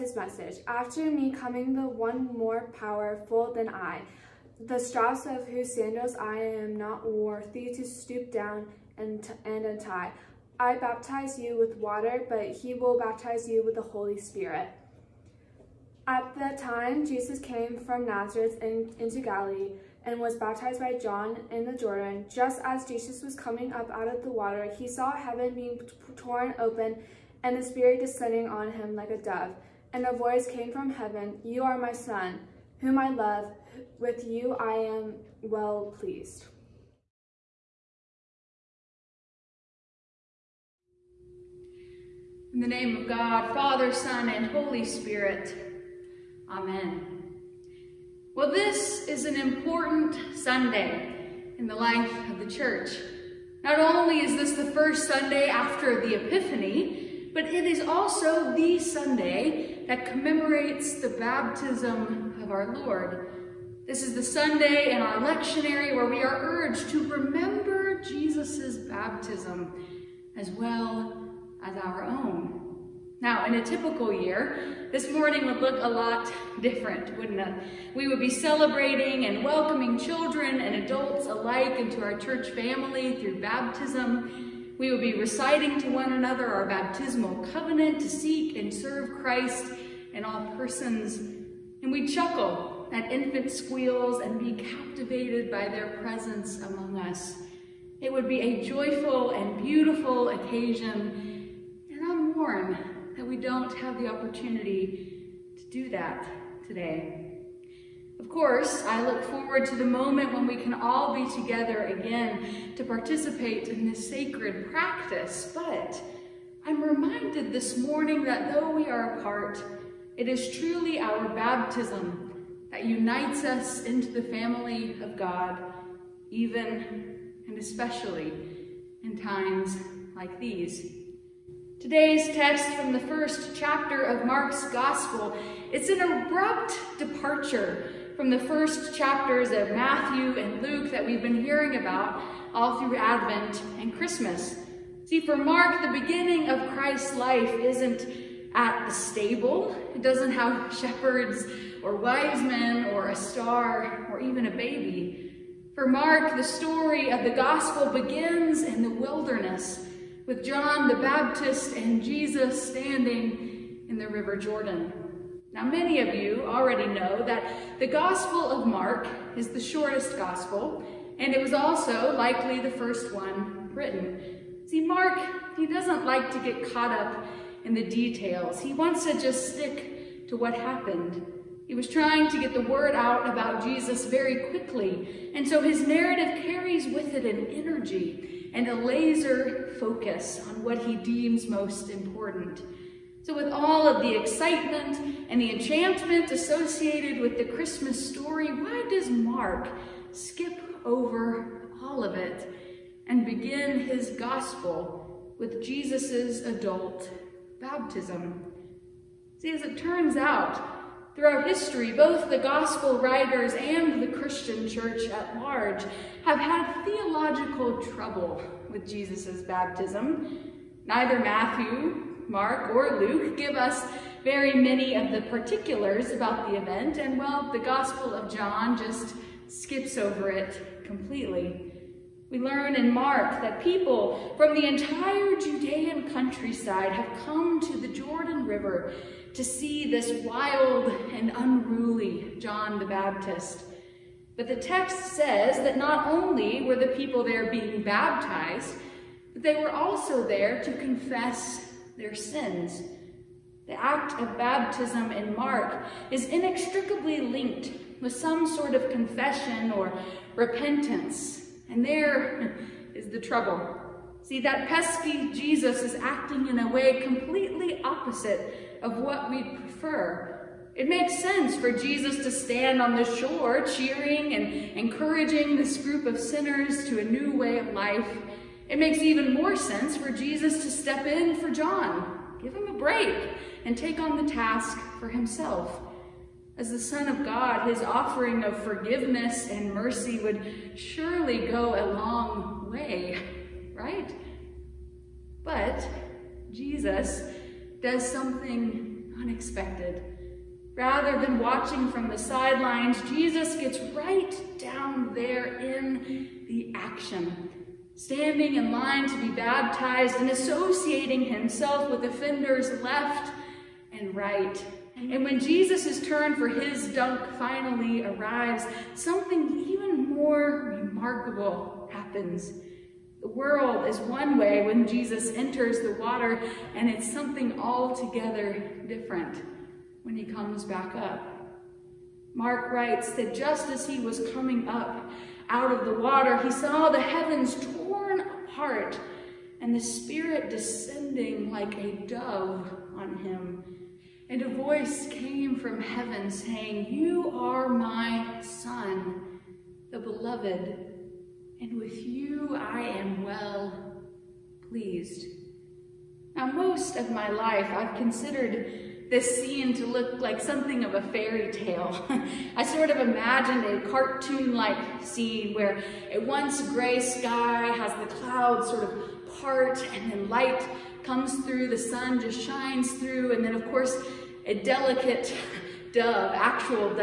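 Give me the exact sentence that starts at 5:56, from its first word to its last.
Now, most of my life, I've considered this scene to look like something of a fairy tale.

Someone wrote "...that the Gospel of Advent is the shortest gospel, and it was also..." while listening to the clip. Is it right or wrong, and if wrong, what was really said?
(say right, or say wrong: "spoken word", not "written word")
wrong: "Mark", not "Advent".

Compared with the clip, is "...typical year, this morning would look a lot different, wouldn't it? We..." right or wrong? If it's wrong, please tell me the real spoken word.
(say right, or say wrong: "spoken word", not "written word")
right.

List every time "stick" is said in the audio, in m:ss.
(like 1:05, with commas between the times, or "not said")
2:59.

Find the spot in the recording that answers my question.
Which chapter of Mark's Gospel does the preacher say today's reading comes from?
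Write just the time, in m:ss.
2:12.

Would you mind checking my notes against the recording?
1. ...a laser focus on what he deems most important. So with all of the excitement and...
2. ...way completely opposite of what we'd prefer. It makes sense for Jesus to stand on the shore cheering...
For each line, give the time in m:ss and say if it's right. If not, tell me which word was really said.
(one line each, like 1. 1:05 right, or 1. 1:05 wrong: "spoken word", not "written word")
1. 3:08 right
2. 4:26 right.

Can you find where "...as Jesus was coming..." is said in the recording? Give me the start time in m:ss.
0:22.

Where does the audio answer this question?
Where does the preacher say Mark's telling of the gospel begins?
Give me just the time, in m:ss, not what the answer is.
2:38.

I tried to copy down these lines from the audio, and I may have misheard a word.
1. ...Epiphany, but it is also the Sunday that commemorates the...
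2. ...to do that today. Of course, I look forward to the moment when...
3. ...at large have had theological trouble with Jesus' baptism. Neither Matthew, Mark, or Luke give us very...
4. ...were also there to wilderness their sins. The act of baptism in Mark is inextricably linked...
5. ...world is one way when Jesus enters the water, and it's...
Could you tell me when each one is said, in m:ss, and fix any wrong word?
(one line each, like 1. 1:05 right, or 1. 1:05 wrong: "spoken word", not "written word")
1. 0:56 right
2. 1:45 right
3. 3:35 right
4. 4:09 wrong: "confess", not "wilderness"
5. 5:23 right.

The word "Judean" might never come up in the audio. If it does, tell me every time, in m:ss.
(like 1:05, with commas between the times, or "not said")
3:55.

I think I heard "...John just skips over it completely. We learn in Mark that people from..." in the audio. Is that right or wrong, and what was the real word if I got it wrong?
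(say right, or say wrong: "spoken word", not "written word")
right.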